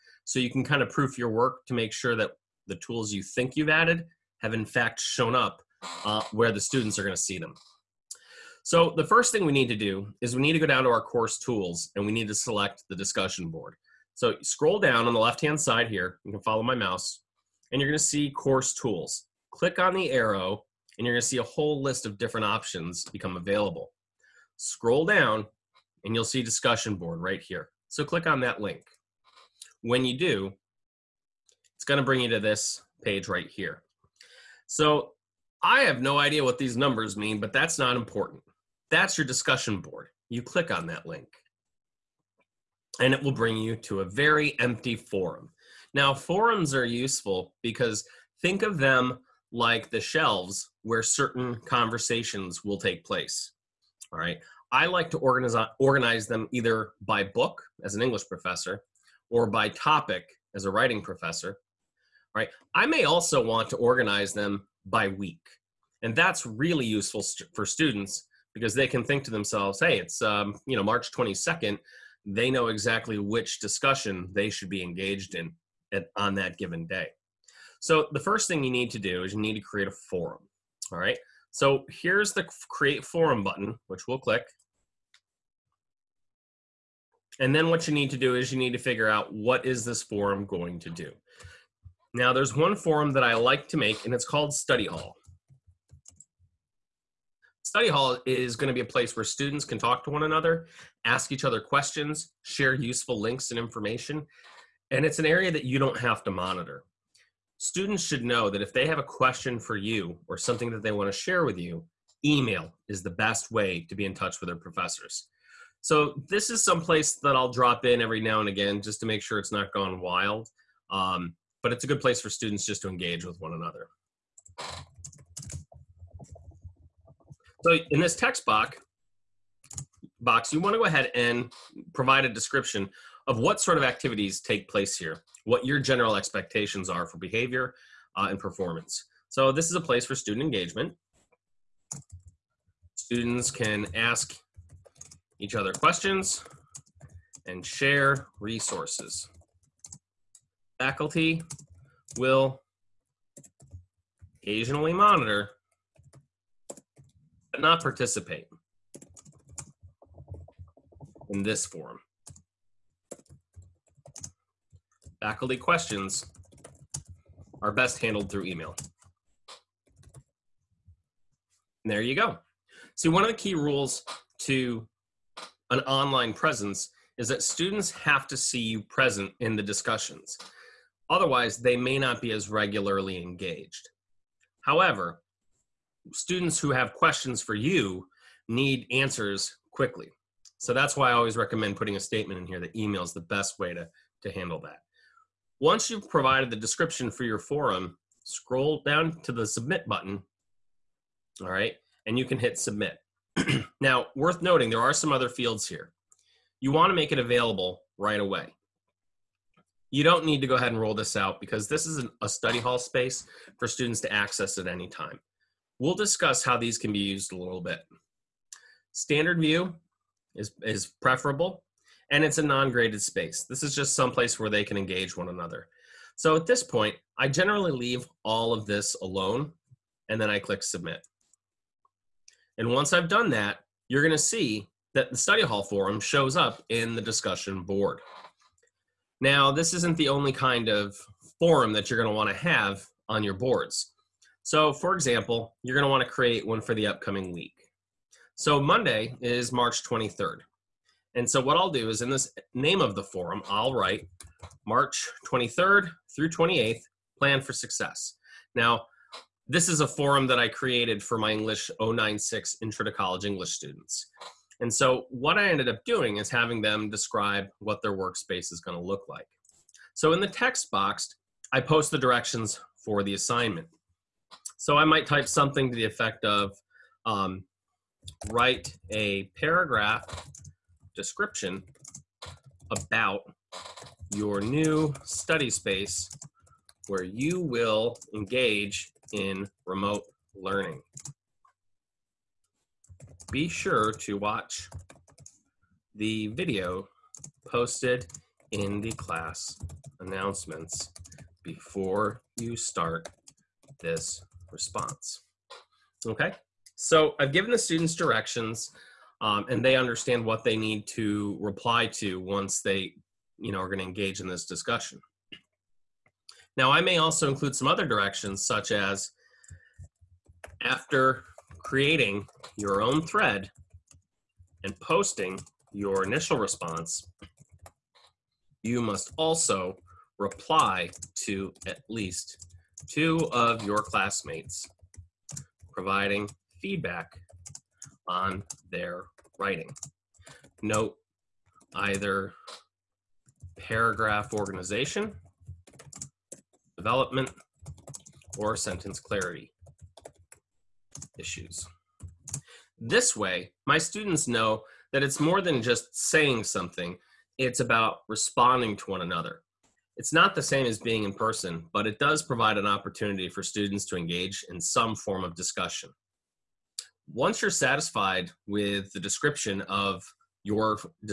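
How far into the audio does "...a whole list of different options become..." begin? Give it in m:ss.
0:21.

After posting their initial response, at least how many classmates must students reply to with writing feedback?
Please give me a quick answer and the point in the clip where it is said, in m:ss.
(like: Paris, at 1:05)
2, at 5:32.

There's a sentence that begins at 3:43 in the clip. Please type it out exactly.
This is just someplace where they can engage one another.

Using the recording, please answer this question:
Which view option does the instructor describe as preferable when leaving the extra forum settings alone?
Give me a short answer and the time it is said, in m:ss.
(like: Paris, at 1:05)
Standard view, at 3:38.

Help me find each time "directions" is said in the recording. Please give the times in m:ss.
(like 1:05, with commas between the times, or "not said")
4:31, 5:07, 5:17.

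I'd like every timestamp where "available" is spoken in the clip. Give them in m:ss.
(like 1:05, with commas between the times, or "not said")
0:23, 3:27.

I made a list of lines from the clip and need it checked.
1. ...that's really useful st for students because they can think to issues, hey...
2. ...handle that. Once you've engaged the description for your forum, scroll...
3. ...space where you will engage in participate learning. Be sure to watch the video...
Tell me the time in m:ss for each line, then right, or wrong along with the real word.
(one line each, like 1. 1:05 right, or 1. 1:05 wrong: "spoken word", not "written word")
1. 1:06 wrong: "themselves", not "issues"
2. 3:14 wrong: "provided", not "engaged"
3. 4:45 wrong: "remote", not "participate".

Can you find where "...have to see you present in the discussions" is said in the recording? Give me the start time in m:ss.
2:57.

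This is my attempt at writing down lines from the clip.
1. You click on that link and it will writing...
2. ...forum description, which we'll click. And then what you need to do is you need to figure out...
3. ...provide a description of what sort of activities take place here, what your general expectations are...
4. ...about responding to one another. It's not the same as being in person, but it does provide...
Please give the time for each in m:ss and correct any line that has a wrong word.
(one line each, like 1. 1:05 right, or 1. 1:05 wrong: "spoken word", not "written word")
1. 0:40 wrong: "bring", not "writing"
2. 1:23 wrong: "button", not "description"
3. 2:11 right
4. 5:57 right.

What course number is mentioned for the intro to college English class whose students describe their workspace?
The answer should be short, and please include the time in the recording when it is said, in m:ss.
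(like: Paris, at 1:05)
English 096, at 4:21.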